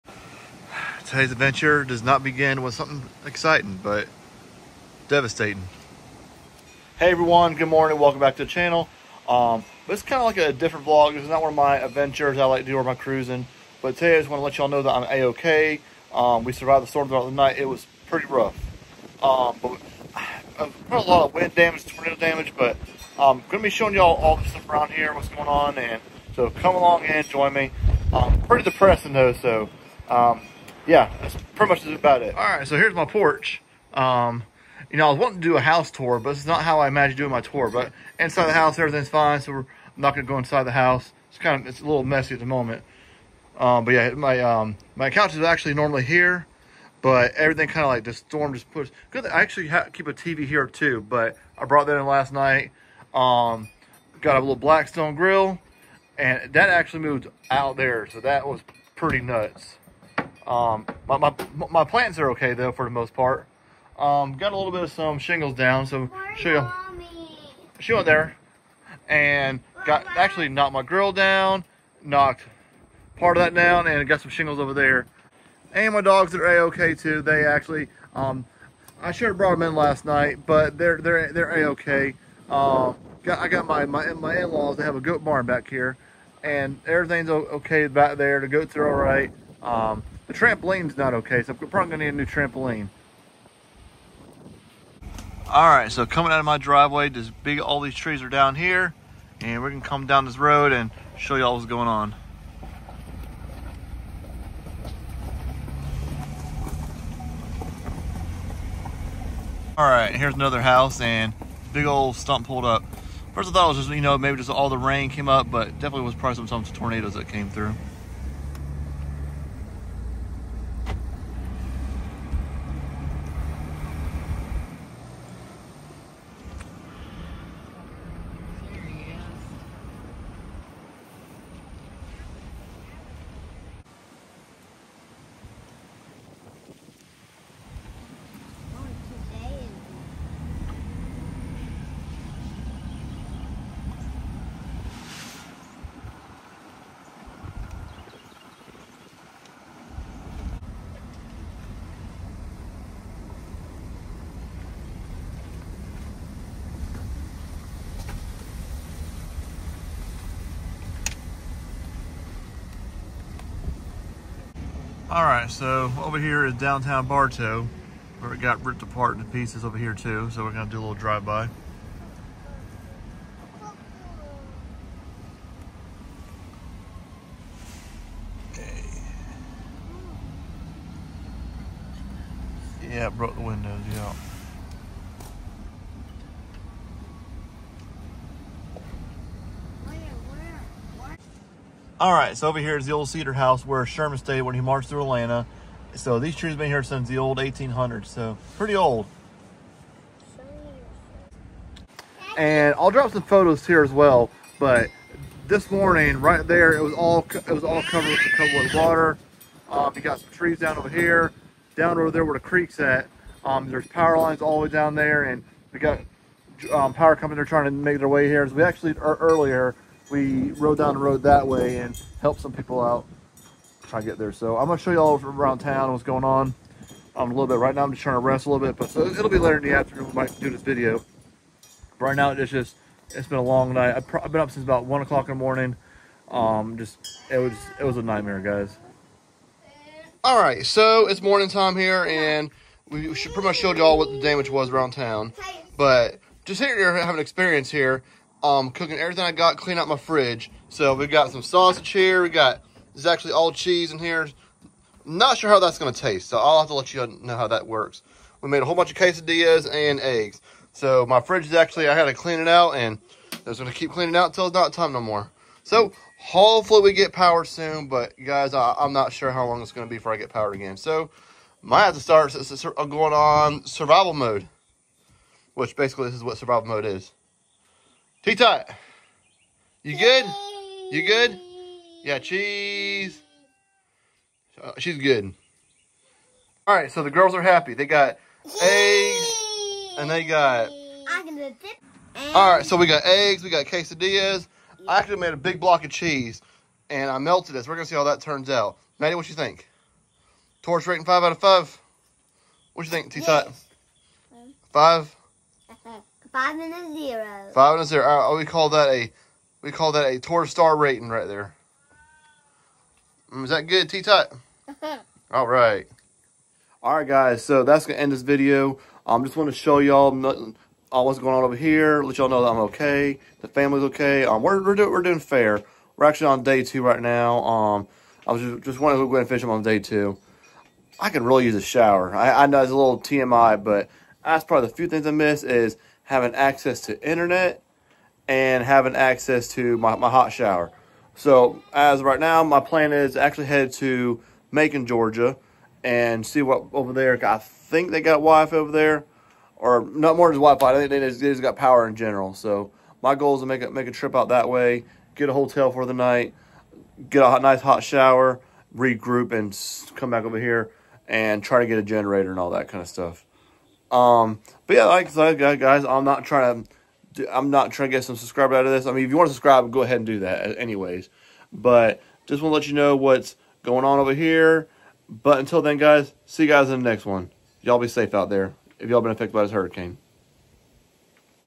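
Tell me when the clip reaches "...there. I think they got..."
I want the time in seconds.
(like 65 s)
346 s.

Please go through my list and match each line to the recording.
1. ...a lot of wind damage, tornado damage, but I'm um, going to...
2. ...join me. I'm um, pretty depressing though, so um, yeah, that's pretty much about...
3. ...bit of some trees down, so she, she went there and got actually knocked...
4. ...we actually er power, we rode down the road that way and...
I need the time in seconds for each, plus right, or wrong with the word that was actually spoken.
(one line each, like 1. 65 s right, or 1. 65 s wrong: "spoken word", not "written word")
1. 20 s right
2. 27 s right
3. 64 s wrong: "shingles", not "trees"
4. 218 s wrong: "earlier", not "power".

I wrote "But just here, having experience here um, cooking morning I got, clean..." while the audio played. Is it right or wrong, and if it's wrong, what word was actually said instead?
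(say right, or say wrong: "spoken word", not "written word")
wrong: "everything", not "morning".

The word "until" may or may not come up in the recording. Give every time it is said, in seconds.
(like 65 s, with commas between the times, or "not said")
264 s, 375 s.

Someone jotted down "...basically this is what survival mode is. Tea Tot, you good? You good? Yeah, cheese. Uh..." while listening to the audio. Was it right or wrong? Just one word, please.
right.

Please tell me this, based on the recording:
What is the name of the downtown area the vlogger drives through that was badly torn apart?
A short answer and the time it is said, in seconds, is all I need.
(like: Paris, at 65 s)
Bartow, at 167 s.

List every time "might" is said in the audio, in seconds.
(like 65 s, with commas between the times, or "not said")
230 s, 271 s.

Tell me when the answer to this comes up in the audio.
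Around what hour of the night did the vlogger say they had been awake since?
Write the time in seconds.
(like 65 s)
234 s.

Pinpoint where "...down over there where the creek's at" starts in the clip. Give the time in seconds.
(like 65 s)
211 s.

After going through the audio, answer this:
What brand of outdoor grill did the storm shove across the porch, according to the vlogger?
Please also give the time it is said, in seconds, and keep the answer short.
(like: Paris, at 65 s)
Blackstone, at 54 s.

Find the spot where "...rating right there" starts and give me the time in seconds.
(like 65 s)
310 s.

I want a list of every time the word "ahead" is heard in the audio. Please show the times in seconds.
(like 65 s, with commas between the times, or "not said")
329 s, 369 s.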